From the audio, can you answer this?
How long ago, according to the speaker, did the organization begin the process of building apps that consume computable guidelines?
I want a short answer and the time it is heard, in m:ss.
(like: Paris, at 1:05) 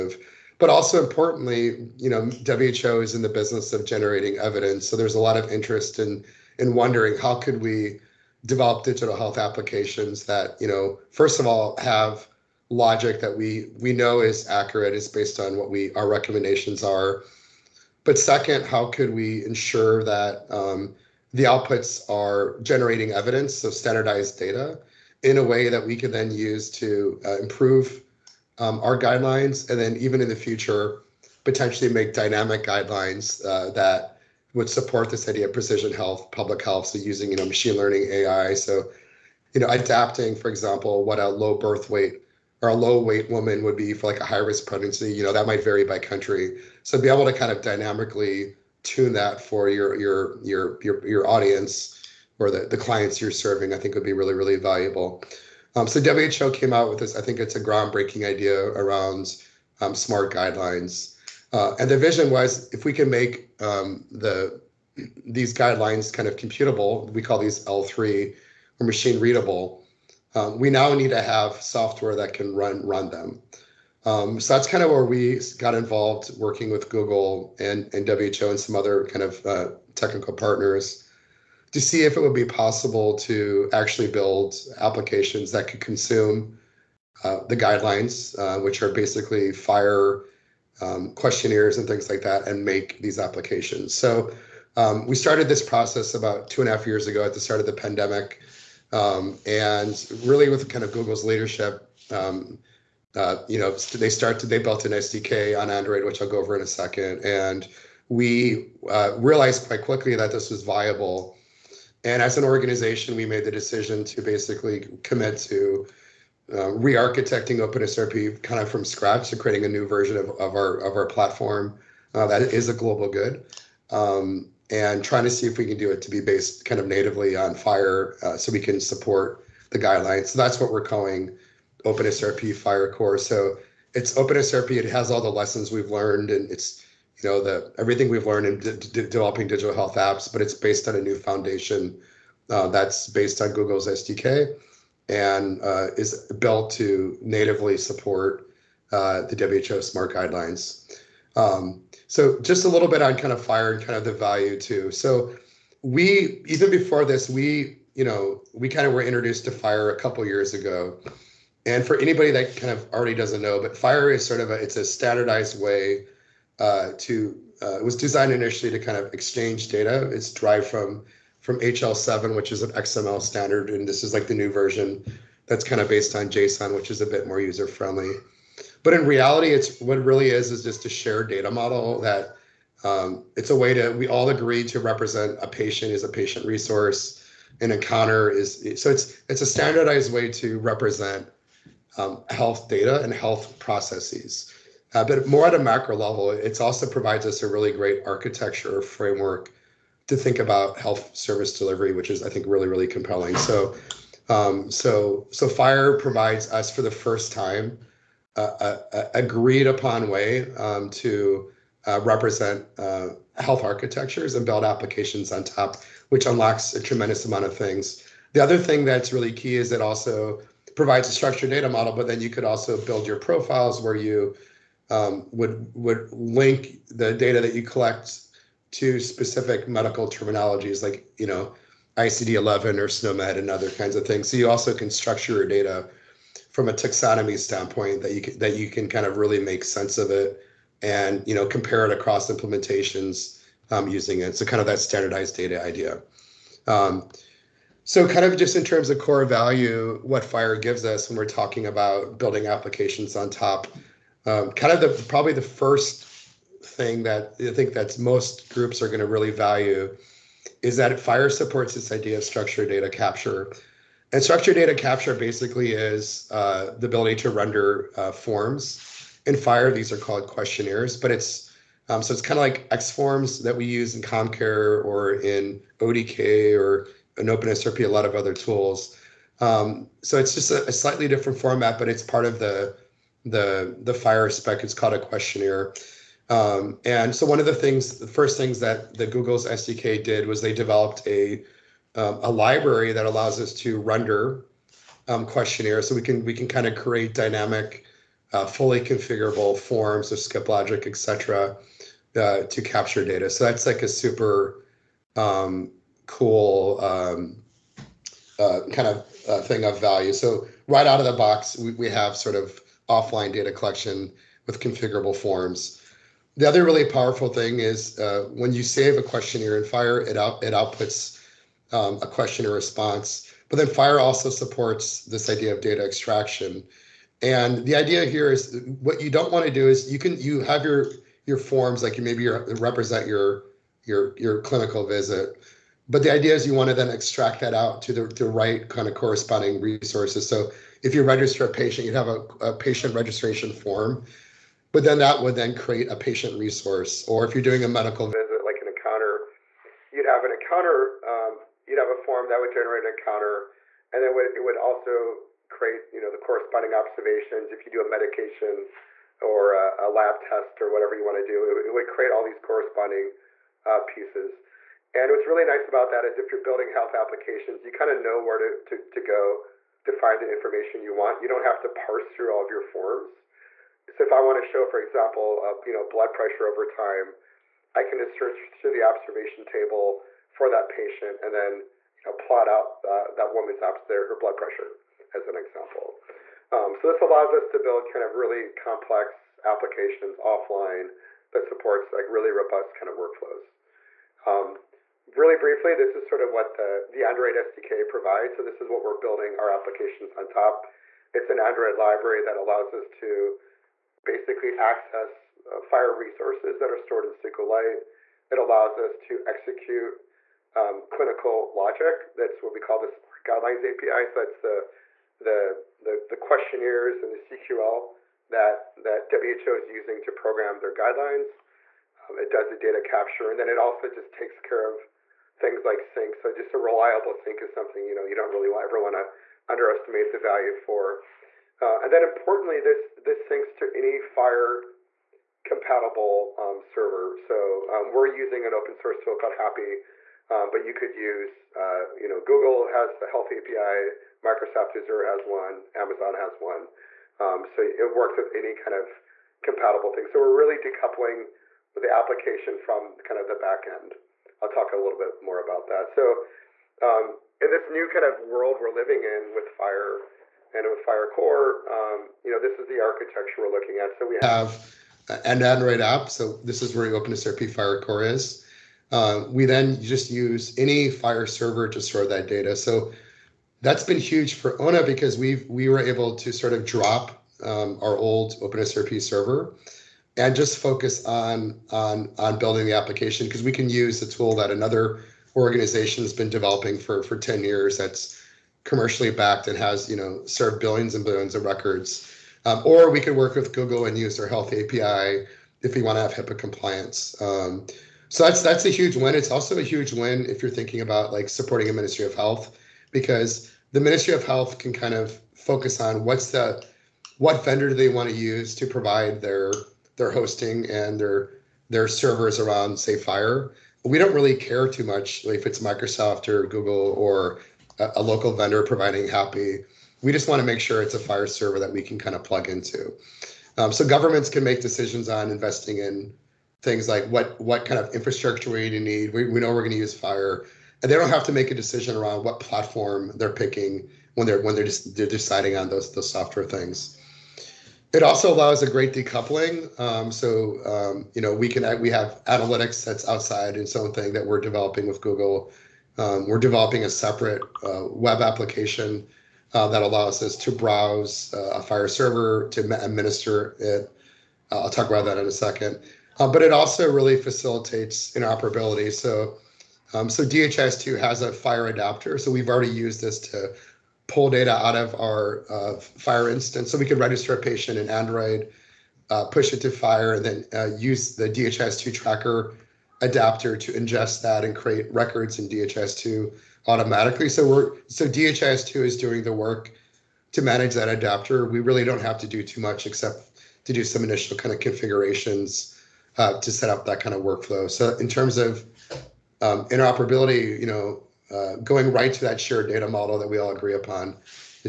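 two and a half years, at 1:36.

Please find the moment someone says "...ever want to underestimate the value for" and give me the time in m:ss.
7:08.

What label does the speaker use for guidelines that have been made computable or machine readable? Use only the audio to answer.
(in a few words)
L3.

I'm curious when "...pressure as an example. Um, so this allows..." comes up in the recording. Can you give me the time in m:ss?
6:24.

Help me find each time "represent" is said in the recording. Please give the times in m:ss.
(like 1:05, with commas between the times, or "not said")
3:04, 3:10, 3:32, 5:32.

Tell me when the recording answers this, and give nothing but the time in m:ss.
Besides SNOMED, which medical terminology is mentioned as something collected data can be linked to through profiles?
3:51.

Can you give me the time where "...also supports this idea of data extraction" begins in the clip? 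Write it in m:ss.
5:24.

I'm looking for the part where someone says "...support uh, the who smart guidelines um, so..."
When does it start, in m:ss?
2:27.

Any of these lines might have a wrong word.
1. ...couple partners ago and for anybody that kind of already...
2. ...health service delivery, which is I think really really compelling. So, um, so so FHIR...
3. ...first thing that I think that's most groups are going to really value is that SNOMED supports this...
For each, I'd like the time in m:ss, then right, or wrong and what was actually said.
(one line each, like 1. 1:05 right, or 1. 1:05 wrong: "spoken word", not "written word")
1. 2:39 wrong: "years", not "partners"
2. 3:20 right
3. 4:15 wrong: "FHIR", not "SNOMED".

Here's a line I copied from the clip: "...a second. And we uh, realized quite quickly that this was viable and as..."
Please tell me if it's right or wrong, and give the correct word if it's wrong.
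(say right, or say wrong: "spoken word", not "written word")
right.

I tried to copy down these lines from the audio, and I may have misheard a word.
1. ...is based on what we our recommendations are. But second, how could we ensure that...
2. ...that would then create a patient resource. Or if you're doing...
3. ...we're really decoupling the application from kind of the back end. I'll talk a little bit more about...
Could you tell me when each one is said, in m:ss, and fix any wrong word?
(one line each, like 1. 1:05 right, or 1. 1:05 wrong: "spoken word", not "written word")
1. 0:14 right
2. 5:44 right
3. 7:30 right.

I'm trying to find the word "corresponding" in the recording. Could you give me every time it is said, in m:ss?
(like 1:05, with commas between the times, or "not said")
5:38, 5:56, 6:02.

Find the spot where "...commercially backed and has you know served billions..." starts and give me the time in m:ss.
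8:08.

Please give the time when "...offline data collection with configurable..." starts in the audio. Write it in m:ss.
5:12.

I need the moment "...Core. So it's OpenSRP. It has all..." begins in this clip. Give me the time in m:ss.
2:12.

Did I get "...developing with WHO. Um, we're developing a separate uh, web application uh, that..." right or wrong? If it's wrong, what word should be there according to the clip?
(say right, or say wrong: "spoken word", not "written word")
wrong: "Google", not "WHO".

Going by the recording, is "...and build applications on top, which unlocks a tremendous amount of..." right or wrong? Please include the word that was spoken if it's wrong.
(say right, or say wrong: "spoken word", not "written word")
right.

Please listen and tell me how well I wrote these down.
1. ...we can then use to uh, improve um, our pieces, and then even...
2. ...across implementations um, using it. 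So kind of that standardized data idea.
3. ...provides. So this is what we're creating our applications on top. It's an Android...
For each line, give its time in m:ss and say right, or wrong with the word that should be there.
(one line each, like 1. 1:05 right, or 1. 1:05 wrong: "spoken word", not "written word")
1. 0:25 wrong: "guidelines", not "pieces"
2. 4:01 right
3. 6:37 wrong: "building", not "creating".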